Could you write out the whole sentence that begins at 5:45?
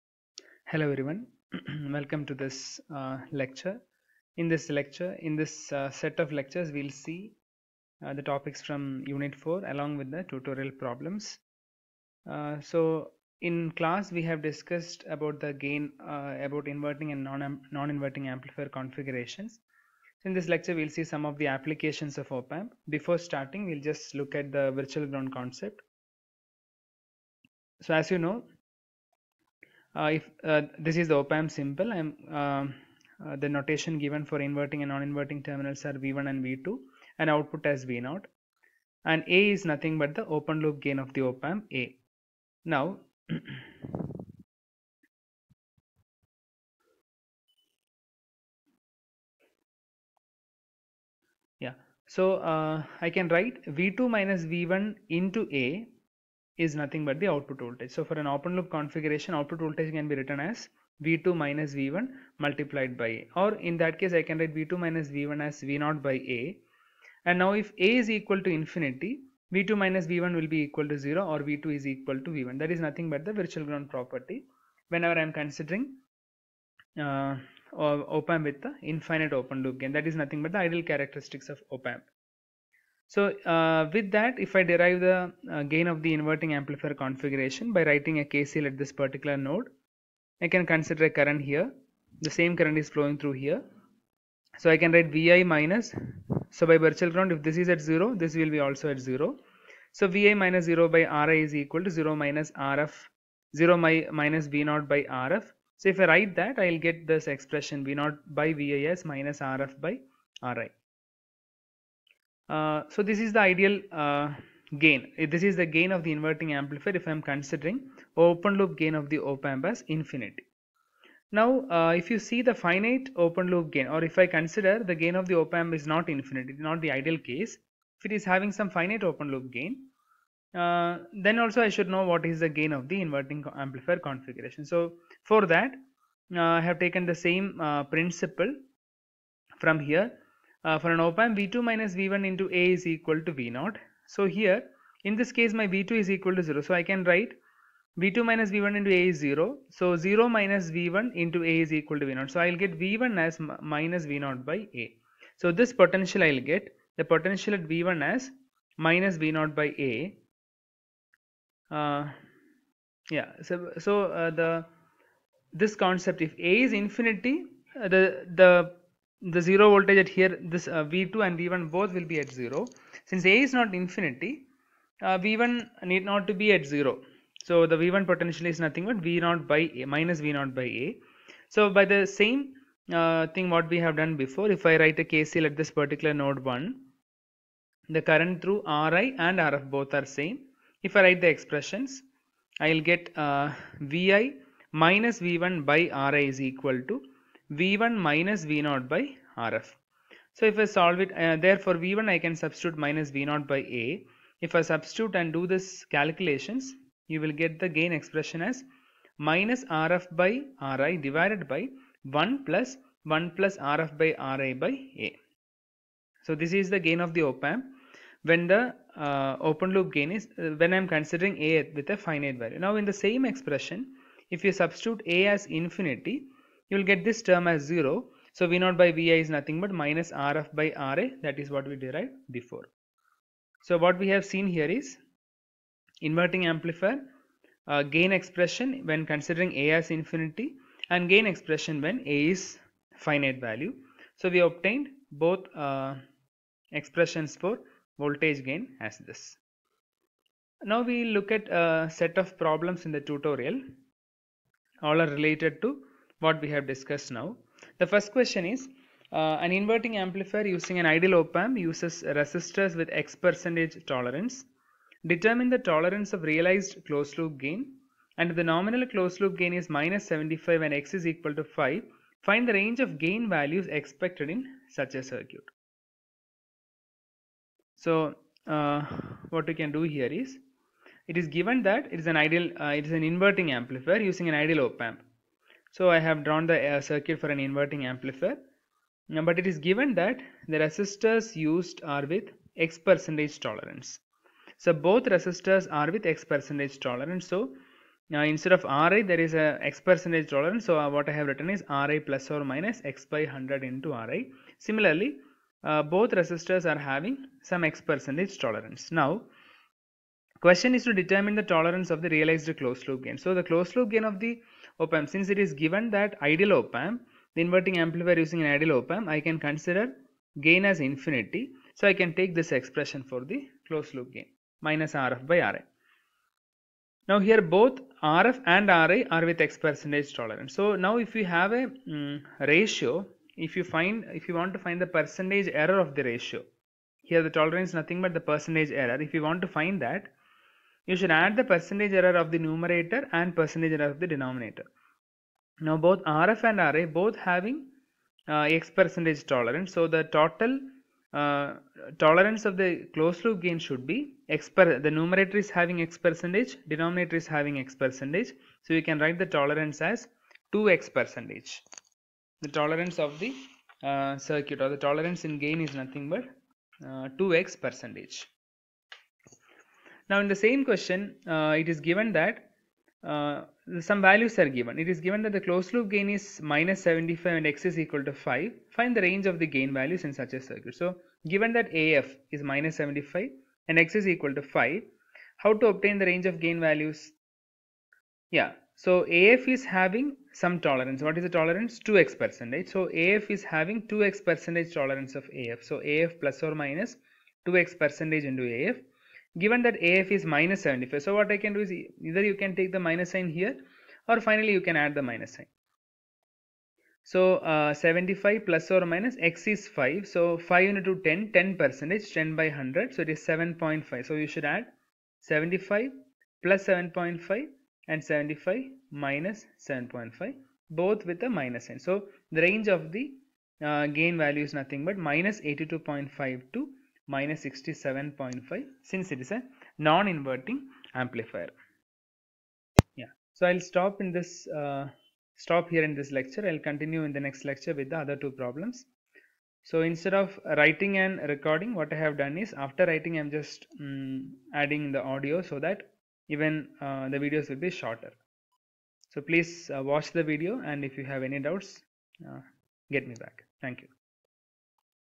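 Now both RF and RA both having uh, X percentage tolerance.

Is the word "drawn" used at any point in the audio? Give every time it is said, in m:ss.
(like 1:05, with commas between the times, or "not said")
4:46.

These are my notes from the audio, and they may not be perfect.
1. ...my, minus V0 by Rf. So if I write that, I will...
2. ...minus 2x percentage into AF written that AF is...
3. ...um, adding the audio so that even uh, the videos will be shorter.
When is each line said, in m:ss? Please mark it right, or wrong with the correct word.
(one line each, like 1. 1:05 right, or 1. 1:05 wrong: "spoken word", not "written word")
1. 1:43 right
2. 6:36 wrong: "given", not "written"
3. 7:23 right.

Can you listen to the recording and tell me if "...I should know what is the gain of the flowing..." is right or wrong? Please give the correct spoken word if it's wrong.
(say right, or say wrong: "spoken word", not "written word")
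wrong: "inverting", not "flowing".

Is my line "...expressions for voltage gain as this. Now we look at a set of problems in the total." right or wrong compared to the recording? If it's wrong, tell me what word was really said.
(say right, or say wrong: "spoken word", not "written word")
wrong: "tutorial", not "total".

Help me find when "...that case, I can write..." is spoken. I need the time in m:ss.
1:03.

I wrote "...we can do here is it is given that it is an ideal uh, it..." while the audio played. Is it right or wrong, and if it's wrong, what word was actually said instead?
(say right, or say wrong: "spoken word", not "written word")
right.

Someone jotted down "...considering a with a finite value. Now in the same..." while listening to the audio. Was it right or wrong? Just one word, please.
right.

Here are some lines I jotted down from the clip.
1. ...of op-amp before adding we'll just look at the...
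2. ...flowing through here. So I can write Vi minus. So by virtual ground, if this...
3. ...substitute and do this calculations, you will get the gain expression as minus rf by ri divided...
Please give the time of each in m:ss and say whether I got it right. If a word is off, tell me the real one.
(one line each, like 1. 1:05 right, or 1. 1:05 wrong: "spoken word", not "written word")
1. 0:22 wrong: "starting", not "adding"
2. 1:32 right
3. 3:24 right.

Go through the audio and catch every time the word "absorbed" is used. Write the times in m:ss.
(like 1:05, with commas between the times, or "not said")
not said.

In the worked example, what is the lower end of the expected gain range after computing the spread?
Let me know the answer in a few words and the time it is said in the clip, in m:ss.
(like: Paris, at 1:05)
-67.5, at 7:07.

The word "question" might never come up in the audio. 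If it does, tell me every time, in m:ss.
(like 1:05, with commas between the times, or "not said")
4:18, 5:10, 6:10.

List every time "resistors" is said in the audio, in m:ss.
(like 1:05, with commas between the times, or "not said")
4:22, 4:50, 4:55, 5:06.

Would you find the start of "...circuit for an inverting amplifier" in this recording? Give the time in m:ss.
4:46.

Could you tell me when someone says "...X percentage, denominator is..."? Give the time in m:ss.
5:55.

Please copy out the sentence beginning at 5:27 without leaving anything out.
Now here both Rf and Ra are with X percentage tolerance.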